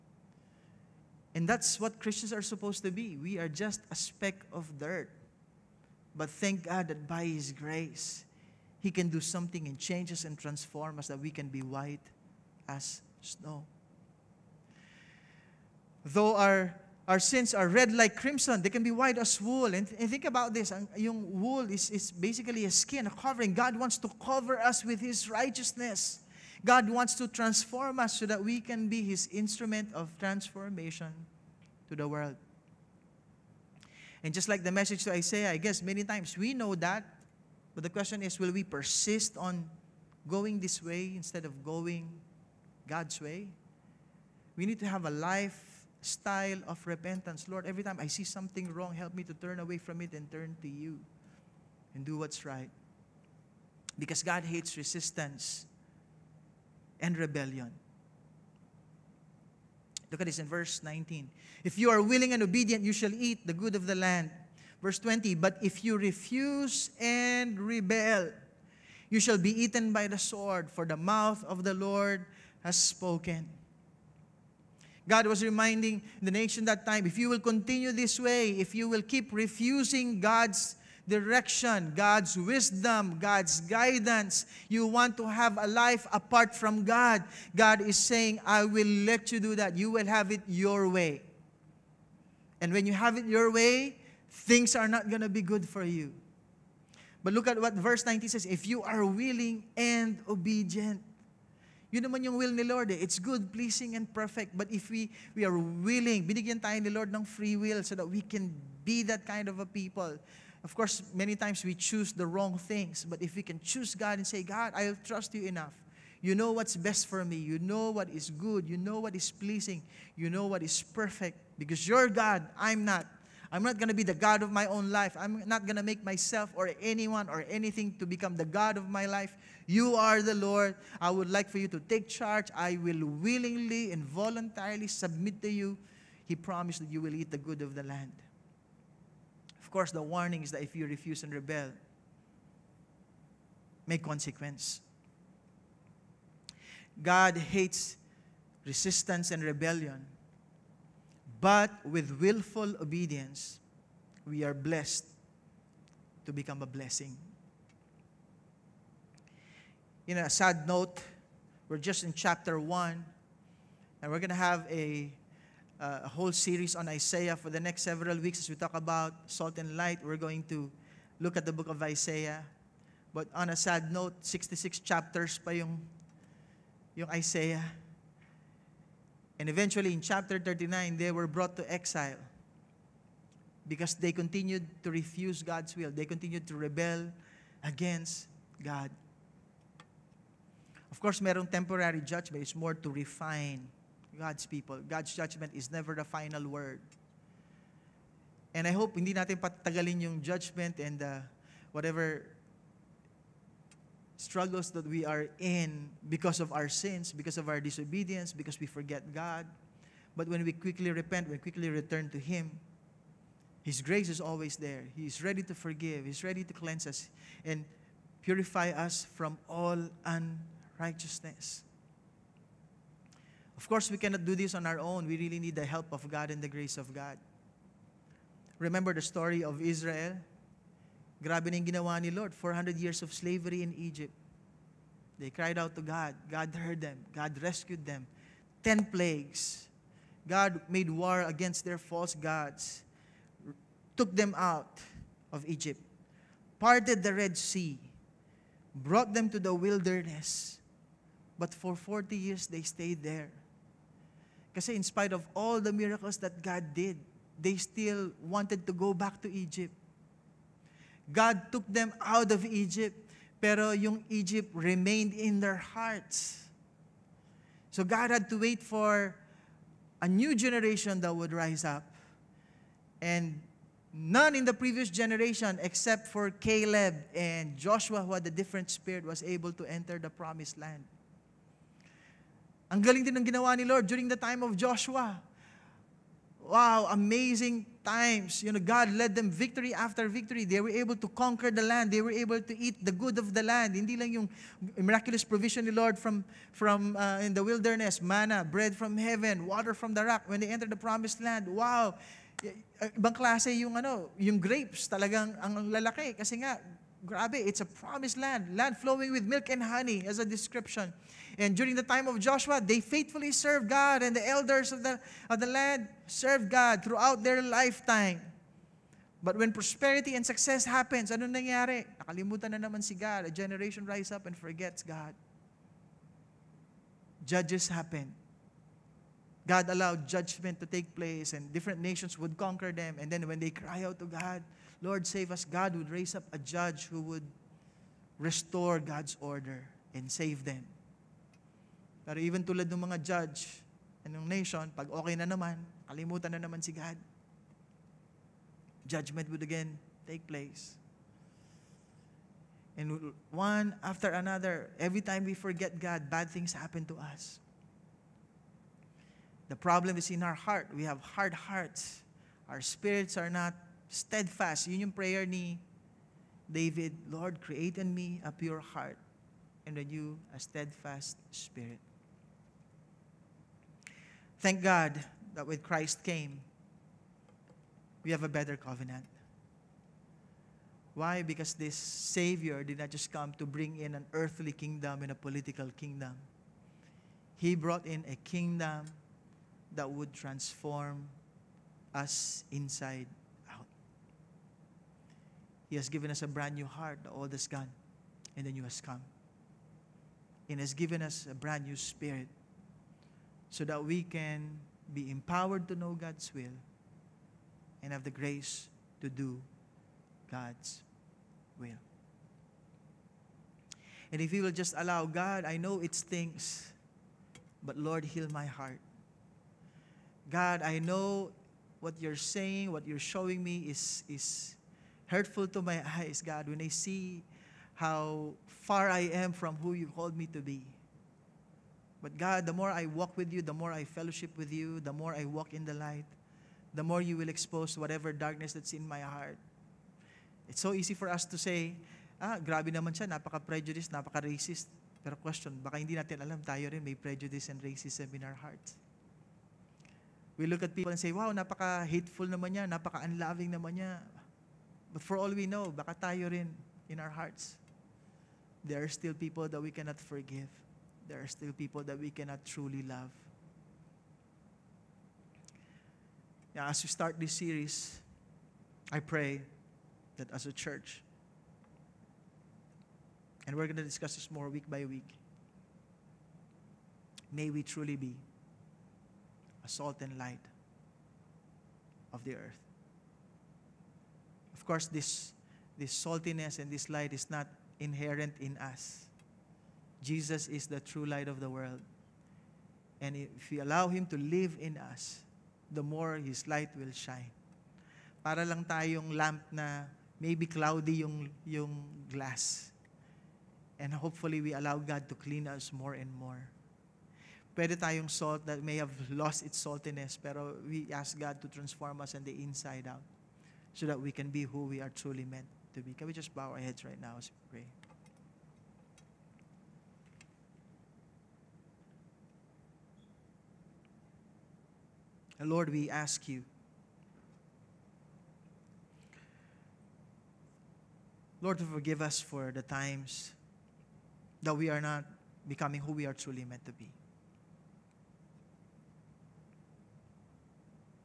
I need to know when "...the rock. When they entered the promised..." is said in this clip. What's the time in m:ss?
4:59.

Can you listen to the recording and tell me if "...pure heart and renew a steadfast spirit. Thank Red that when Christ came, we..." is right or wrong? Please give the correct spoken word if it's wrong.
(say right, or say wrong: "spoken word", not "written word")
wrong: "God", not "Red".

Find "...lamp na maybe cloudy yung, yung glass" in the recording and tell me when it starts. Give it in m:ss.
8:19.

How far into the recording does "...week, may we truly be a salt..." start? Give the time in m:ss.
7:54.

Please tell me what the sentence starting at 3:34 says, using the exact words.
He is ready to forgive, He's ready to cleanse us and purify us from all unrighteousness.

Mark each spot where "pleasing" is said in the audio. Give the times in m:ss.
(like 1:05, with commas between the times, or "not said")
1:43, 1:59.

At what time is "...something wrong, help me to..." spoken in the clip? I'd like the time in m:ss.
0:48.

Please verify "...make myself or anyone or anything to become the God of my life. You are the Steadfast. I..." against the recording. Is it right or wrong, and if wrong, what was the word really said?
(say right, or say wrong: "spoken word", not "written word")
wrong: "Lord", not "Steadfast".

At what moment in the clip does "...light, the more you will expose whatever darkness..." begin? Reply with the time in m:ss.
7:15.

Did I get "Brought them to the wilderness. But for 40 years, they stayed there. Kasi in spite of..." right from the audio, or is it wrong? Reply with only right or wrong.
right.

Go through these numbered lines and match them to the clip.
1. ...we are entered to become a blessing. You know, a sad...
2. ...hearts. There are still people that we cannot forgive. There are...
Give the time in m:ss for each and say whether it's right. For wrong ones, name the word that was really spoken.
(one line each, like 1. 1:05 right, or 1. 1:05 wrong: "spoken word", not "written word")
1. 2:34 wrong: "blessed", not "entered"
2. 7:37 right.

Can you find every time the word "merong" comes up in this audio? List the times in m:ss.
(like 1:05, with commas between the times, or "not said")
3:11.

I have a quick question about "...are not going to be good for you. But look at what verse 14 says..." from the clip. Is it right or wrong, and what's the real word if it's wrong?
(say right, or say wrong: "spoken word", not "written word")
wrong: "19", not "14".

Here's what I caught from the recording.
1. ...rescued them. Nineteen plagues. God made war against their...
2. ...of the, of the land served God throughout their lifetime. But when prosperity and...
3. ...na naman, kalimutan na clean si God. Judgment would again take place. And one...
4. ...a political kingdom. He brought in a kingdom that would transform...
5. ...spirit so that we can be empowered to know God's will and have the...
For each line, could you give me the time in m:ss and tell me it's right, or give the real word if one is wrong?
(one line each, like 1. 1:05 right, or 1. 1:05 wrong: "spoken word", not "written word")
1. 3:57 wrong: "Ten", not "Nineteen"
2. 5:14 right
3. 5:45 wrong: "naman", not "clean"
4. 6:25 right
5. 6:41 right.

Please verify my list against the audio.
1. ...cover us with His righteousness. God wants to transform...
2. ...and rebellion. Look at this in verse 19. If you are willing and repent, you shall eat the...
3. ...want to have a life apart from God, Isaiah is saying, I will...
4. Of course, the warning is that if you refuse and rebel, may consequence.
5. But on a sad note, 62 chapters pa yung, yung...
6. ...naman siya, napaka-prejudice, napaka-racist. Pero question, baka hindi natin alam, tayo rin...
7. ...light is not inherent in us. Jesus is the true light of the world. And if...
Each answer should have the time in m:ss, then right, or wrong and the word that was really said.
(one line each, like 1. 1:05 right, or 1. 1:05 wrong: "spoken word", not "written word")
1. 0:24 right
2. 0:56 wrong: "obedient", not "repent"
3. 1:24 wrong: "God", not "Isaiah"
4. 2:19 right
5. 2:53 wrong: "66", not "62"
6. 7:22 right
7. 8:06 right.